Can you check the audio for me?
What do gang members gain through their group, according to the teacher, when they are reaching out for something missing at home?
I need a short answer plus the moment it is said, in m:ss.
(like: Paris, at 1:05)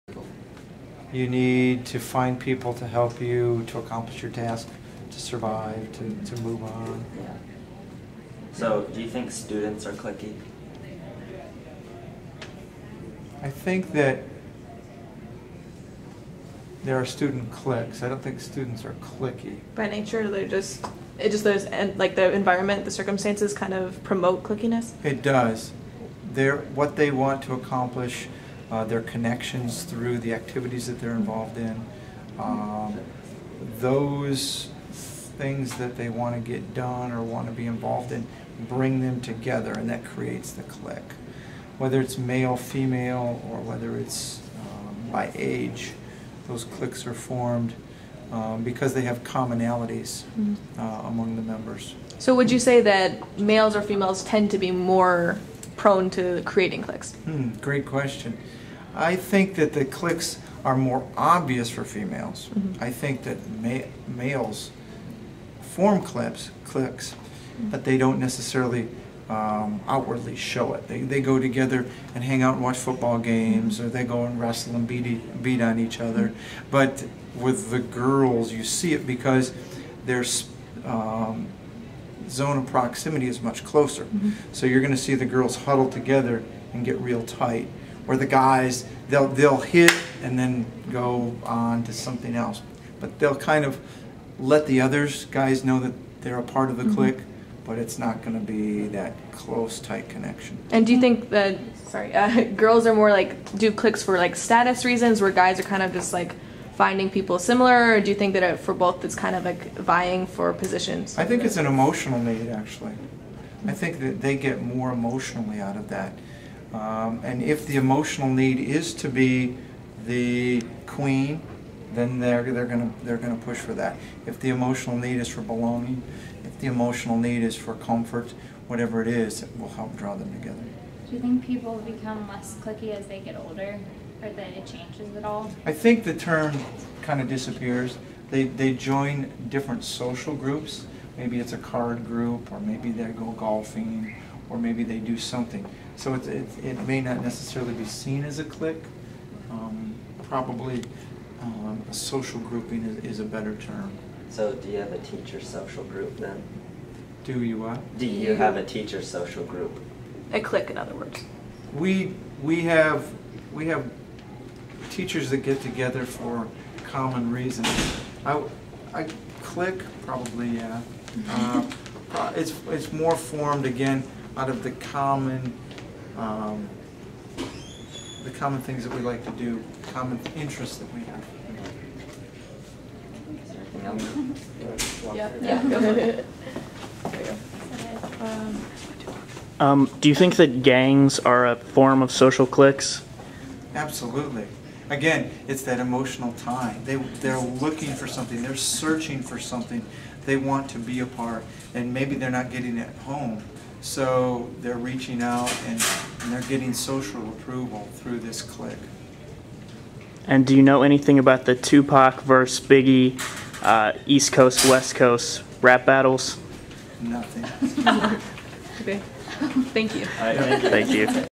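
social approval, at 3:26.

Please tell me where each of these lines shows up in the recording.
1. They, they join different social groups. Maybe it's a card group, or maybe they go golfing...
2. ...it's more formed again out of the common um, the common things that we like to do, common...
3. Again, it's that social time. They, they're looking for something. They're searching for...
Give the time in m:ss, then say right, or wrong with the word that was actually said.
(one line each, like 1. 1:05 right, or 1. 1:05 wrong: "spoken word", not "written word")
1. 2:18 right
2. 2:52 right
3. 3:14 wrong: "emotional", not "social".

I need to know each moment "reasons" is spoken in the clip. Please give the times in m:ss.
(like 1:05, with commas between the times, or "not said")
1:44, 2:47.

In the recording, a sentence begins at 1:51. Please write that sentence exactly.
I think it's an emotional need, actually.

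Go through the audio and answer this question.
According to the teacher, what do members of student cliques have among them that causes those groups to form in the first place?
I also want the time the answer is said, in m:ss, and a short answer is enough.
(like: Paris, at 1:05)
commonalities, at 0:49.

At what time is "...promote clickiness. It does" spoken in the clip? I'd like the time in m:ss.
0:24.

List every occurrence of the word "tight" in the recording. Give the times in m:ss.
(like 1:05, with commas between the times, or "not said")
1:27, 1:39.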